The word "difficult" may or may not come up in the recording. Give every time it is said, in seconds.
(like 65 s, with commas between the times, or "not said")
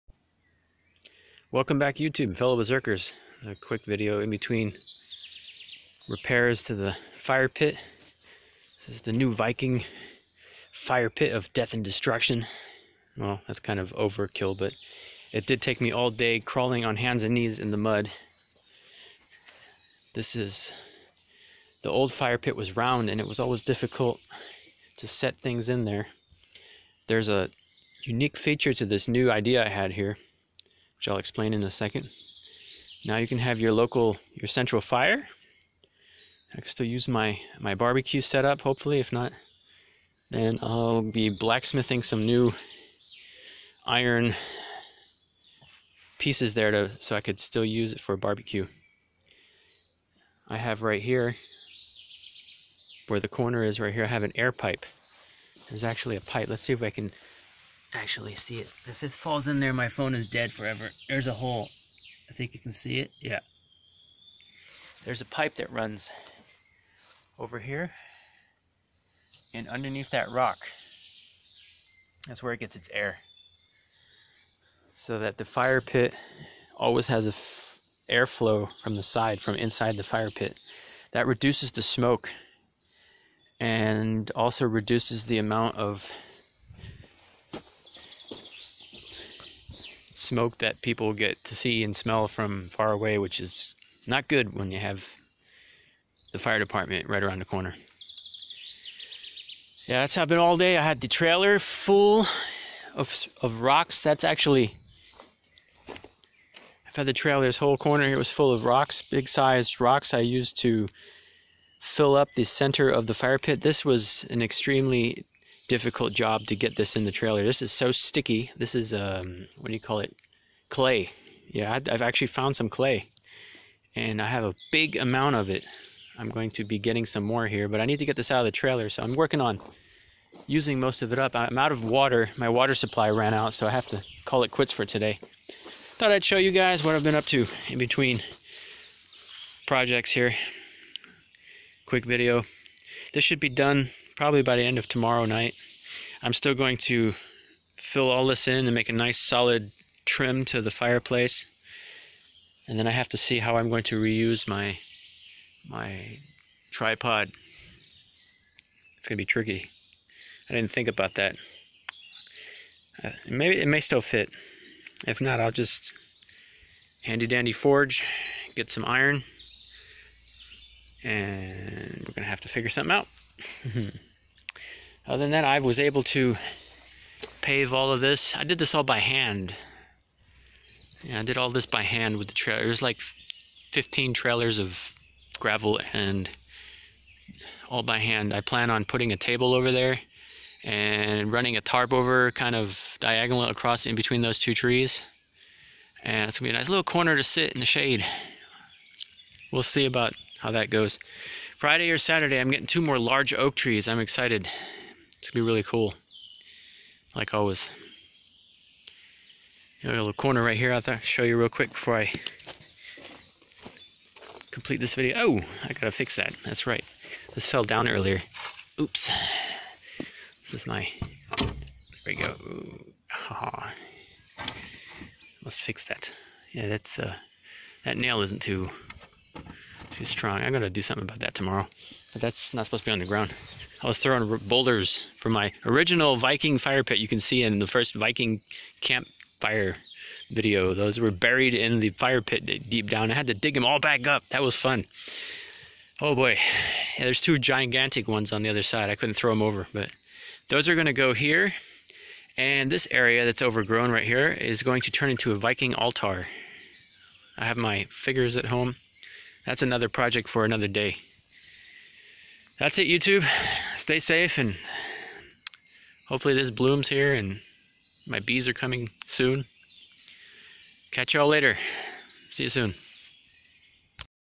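23 s, 115 s.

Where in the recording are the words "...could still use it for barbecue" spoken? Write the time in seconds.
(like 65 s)
47 s.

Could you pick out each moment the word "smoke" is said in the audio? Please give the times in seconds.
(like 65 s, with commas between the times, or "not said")
81 s, 90 s.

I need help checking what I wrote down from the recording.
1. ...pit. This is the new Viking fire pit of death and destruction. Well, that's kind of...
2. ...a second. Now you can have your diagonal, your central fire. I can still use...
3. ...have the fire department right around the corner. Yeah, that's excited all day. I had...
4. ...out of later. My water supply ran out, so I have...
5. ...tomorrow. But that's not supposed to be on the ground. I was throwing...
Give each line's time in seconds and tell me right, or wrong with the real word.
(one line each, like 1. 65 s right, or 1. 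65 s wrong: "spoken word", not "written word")
1. 7 s right
2. 31 s wrong: "local", not "diagonal"
3. 94 s wrong: "happened", not "excited"
4. 131 s wrong: "water", not "later"
5. 231 s right.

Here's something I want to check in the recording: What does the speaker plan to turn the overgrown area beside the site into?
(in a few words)
A Viking altar.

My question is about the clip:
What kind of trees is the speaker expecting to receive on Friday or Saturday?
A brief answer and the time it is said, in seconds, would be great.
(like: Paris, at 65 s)
Oak trees, at 203 s.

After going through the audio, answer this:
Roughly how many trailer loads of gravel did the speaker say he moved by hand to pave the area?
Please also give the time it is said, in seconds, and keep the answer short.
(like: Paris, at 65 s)
15, at 183 s.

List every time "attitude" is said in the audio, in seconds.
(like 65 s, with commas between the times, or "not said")
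not said.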